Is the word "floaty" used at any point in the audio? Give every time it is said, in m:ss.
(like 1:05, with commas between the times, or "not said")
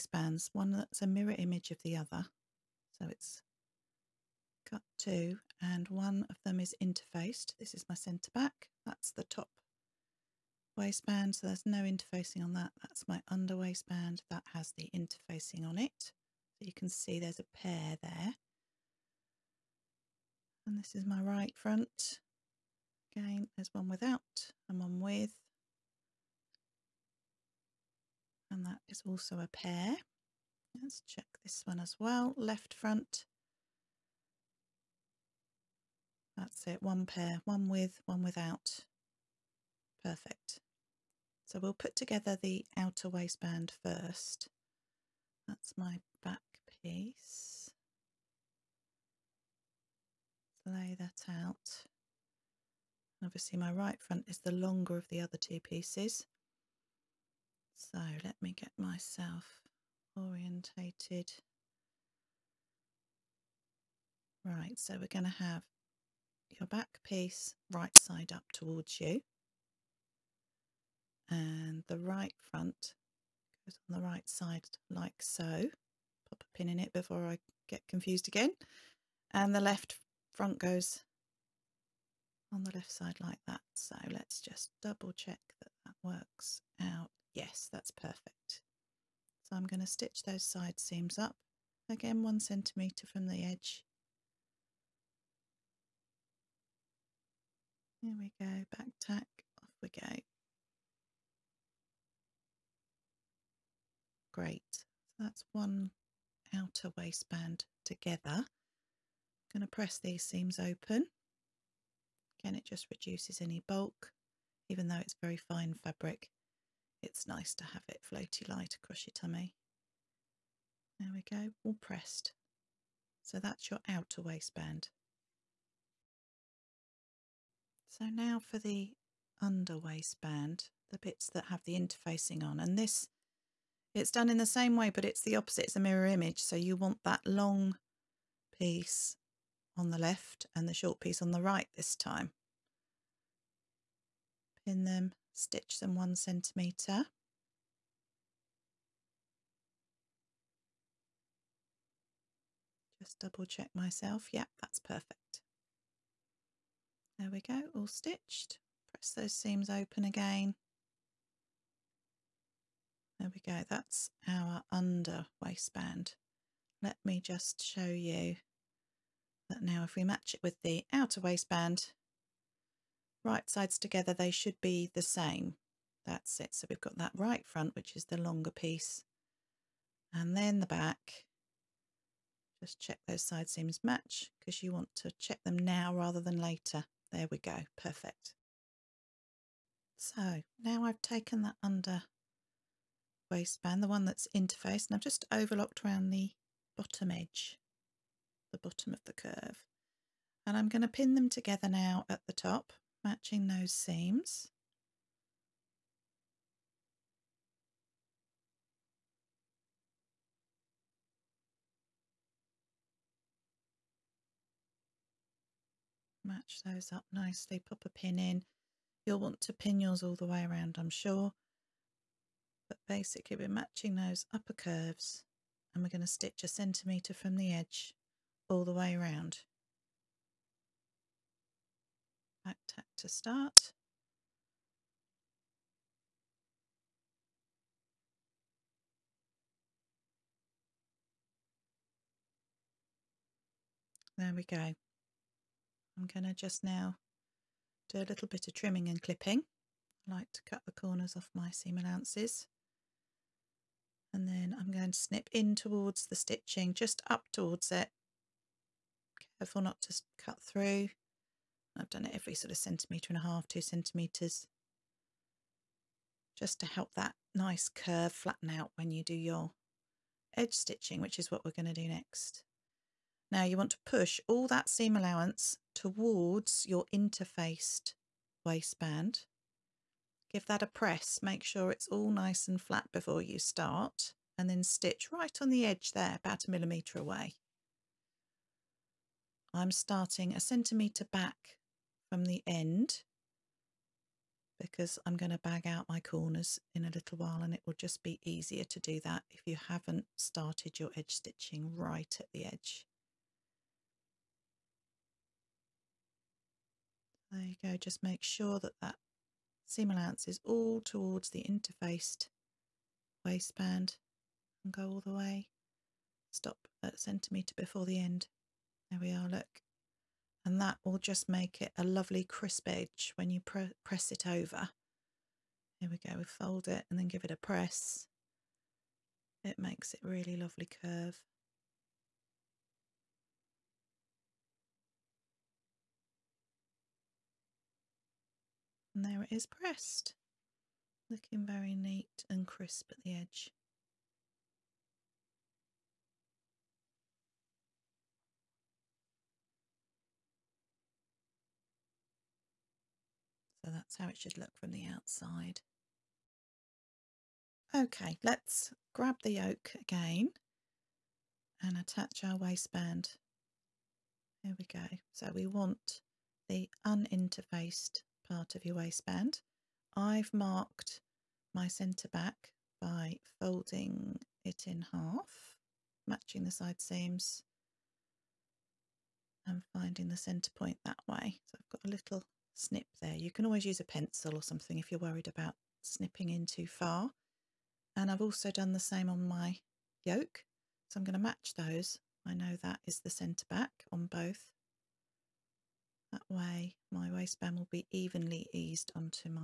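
1:58.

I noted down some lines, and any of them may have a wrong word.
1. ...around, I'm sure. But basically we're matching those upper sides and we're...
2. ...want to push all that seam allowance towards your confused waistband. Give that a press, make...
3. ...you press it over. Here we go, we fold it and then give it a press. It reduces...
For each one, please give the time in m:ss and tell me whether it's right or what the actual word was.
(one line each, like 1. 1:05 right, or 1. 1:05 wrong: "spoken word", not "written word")
1. 3:40 wrong: "curves", not "sides"
2. 4:33 wrong: "interfaced", not "confused"
3. 5:23 wrong: "makes", not "reduces".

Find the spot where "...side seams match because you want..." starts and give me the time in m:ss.
3:03.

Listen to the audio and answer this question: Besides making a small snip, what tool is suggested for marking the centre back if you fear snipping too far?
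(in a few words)
a pencil.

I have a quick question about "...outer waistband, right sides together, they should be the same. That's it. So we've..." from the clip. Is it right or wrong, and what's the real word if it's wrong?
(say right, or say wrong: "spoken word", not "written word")
right.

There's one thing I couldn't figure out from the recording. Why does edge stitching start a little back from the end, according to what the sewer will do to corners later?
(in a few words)
bag out.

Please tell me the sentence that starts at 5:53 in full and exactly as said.
So that's how it should look from the outside.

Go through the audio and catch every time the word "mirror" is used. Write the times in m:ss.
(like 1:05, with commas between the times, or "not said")
0:01, 2:15.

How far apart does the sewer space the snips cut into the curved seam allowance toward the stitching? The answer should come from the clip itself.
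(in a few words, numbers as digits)
1.5 to 2 centimetres.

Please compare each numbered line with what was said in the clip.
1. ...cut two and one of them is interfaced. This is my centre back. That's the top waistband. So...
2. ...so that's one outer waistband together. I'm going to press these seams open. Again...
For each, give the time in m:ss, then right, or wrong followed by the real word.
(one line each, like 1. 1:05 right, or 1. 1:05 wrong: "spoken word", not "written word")
1. 0:04 right
2. 1:44 right.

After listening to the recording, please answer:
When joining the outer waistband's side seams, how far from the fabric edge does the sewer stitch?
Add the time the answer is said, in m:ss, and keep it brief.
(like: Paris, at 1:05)
1 centimetre, at 1:32.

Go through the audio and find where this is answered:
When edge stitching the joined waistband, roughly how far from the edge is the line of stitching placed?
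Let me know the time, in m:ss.
4:46.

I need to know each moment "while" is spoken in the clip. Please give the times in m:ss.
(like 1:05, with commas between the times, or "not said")
4:57.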